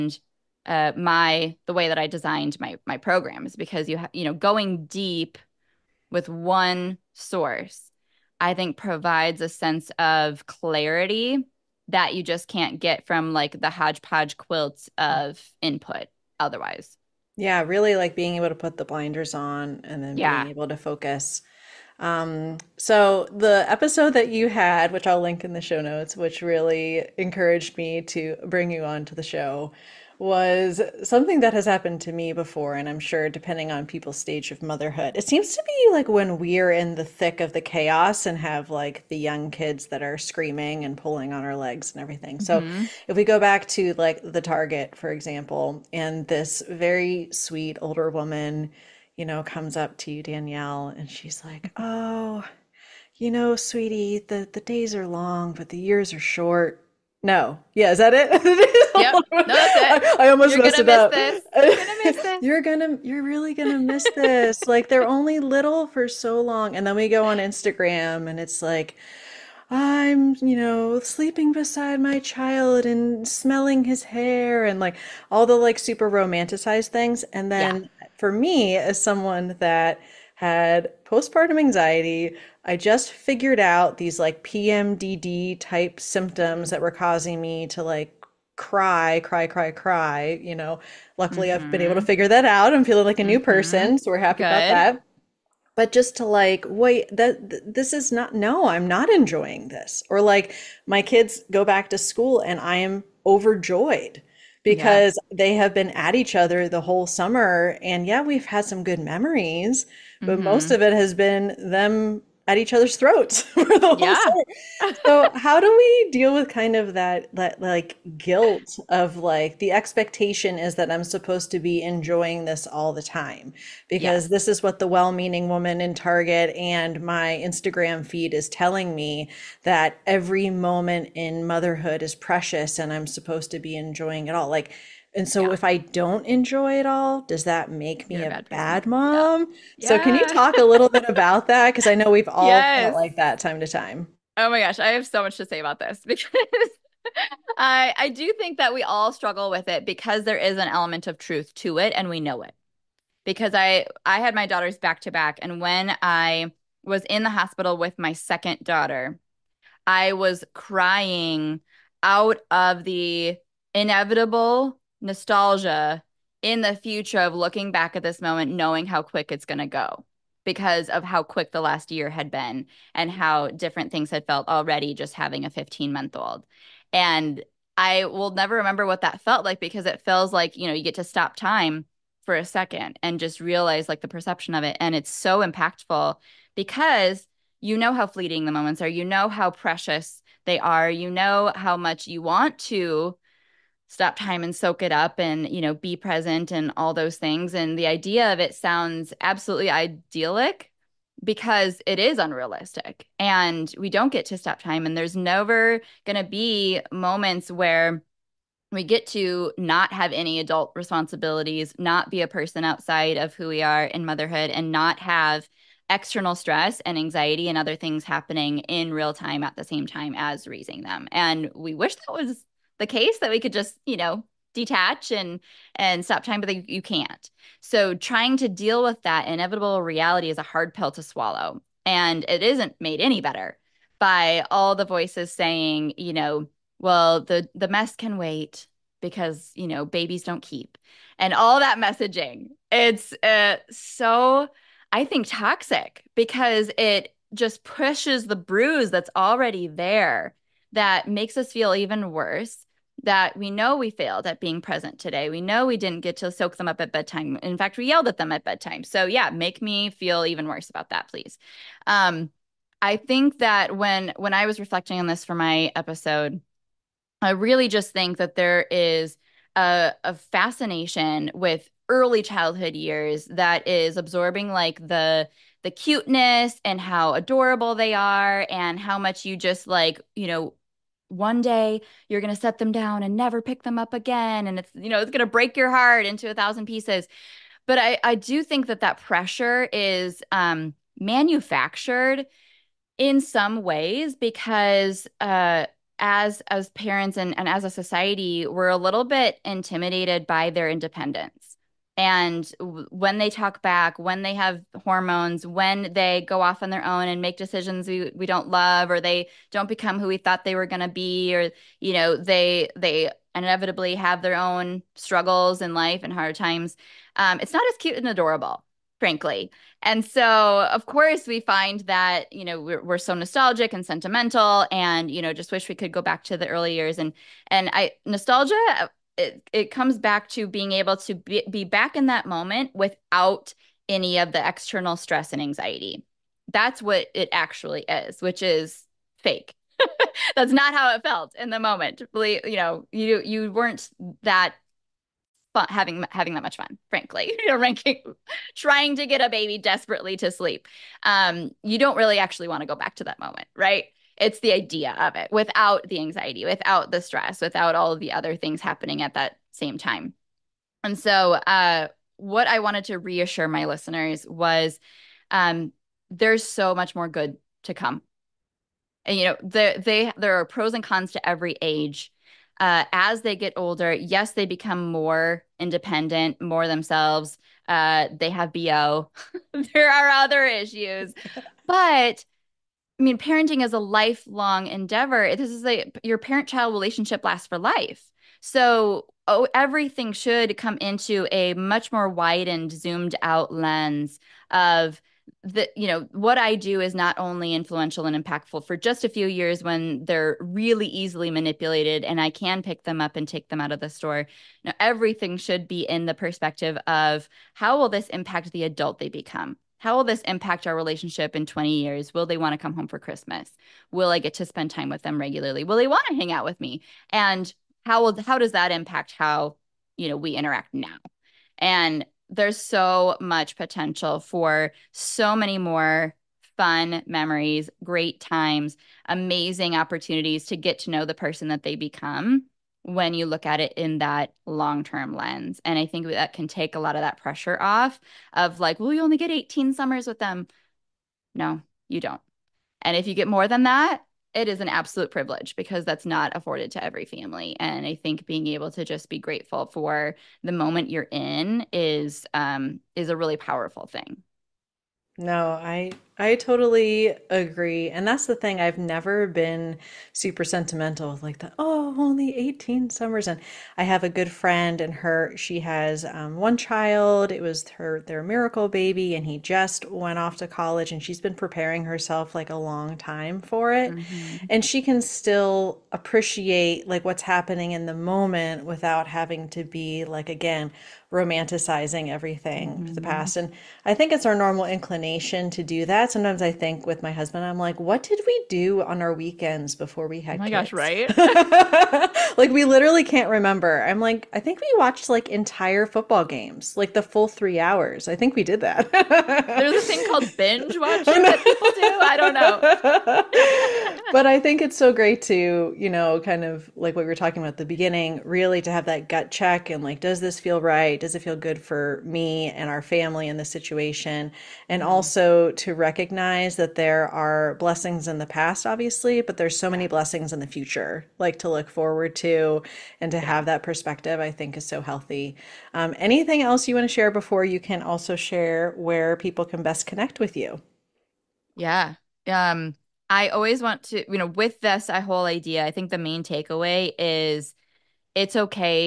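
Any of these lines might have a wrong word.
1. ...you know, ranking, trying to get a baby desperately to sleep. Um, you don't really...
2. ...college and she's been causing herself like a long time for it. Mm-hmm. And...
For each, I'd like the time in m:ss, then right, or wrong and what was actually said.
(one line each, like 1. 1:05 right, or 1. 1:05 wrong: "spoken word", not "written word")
1. 5:47 right
2. 7:50 wrong: "preparing", not "causing".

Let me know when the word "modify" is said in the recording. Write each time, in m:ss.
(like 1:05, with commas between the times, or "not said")
not said.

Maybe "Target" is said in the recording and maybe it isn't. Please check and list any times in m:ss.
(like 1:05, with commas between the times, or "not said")
0:44, 2:05.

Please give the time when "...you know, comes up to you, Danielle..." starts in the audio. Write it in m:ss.
0:49.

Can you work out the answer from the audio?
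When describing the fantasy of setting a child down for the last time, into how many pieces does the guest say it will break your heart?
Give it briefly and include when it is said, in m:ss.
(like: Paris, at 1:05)
1000, at 4:46.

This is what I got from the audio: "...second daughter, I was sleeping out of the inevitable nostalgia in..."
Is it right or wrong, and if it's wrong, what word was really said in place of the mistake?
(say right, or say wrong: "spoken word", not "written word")
wrong: "crying", not "sleeping".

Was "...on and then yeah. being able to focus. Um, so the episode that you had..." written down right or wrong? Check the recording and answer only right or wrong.
right.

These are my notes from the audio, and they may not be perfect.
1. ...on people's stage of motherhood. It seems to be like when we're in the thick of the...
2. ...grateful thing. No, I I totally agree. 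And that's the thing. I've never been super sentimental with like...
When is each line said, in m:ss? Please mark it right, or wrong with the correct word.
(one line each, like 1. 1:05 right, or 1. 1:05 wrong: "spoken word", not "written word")
1. 0:33 right
2. 7:33 wrong: "powerful", not "grateful".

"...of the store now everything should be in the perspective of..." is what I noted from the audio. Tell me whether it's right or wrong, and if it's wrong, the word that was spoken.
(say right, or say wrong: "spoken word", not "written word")
right.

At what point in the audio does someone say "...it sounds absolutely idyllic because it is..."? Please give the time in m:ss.
3:18.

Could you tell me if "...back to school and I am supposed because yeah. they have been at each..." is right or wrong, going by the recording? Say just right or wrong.
wrong.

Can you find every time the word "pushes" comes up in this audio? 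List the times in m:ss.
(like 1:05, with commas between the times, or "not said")
4:07.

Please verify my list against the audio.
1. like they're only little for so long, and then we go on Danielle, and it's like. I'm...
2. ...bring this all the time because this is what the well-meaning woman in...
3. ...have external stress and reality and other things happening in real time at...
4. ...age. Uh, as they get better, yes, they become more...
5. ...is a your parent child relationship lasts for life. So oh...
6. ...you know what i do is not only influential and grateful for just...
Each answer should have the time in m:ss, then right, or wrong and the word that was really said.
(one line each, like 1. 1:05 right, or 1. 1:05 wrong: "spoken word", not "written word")
1. 1:04 wrong: "Instagram", not "Danielle"
2. 2:01 wrong: "enjoying", not "bring"
3. 3:34 wrong: "anxiety", not "reality"
4. 6:11 wrong: "older", not "better"
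5. 6:25 right
6. 6:35 wrong: "impactful", not "grateful".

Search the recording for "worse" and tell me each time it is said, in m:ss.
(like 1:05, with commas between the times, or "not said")
4:12, 4:20.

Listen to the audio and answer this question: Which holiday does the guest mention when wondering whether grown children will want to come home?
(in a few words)
Christmas.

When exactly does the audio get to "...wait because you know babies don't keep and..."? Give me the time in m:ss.
3:58.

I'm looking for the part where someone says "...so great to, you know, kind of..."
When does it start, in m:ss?
8:24.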